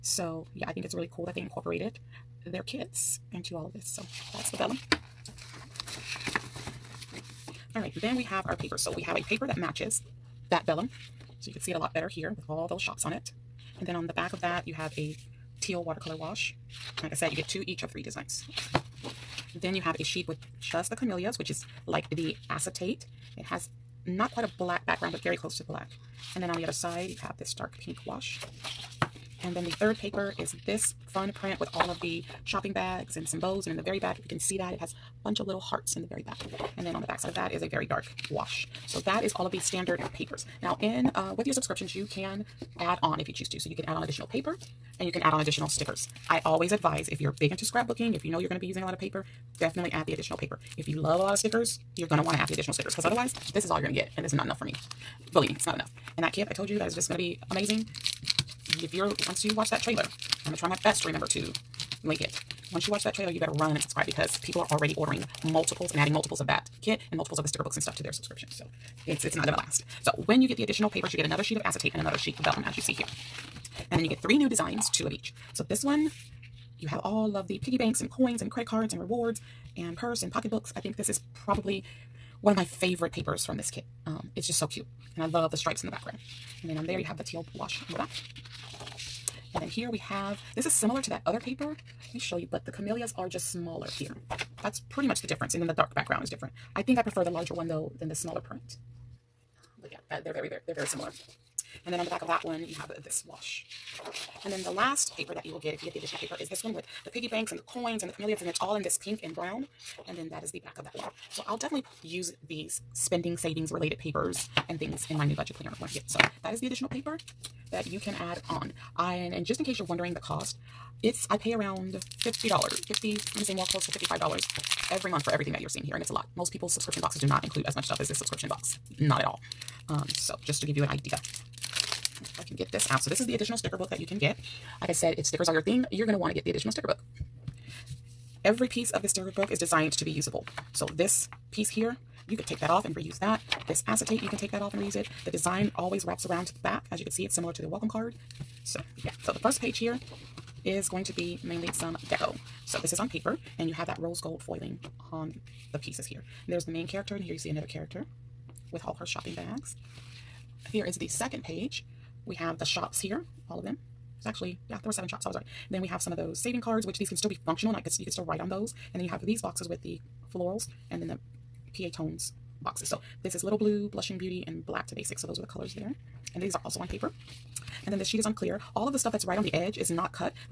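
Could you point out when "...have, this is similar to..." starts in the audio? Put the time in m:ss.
1:29.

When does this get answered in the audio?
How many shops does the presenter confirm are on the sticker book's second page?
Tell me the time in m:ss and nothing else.
2:44.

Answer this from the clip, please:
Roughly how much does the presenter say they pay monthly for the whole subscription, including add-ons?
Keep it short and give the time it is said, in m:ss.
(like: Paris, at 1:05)
$55, at 2:03.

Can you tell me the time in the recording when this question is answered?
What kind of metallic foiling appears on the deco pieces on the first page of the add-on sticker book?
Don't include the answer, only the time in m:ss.
2:33.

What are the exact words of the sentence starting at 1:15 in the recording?
So this one, you have all of the piggy banks and coins and credit cards and rewards and purse and pocketbooks.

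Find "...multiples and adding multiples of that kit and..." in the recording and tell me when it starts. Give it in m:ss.
1:05.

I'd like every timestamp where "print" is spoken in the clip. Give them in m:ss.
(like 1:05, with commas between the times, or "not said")
0:31, 1:38.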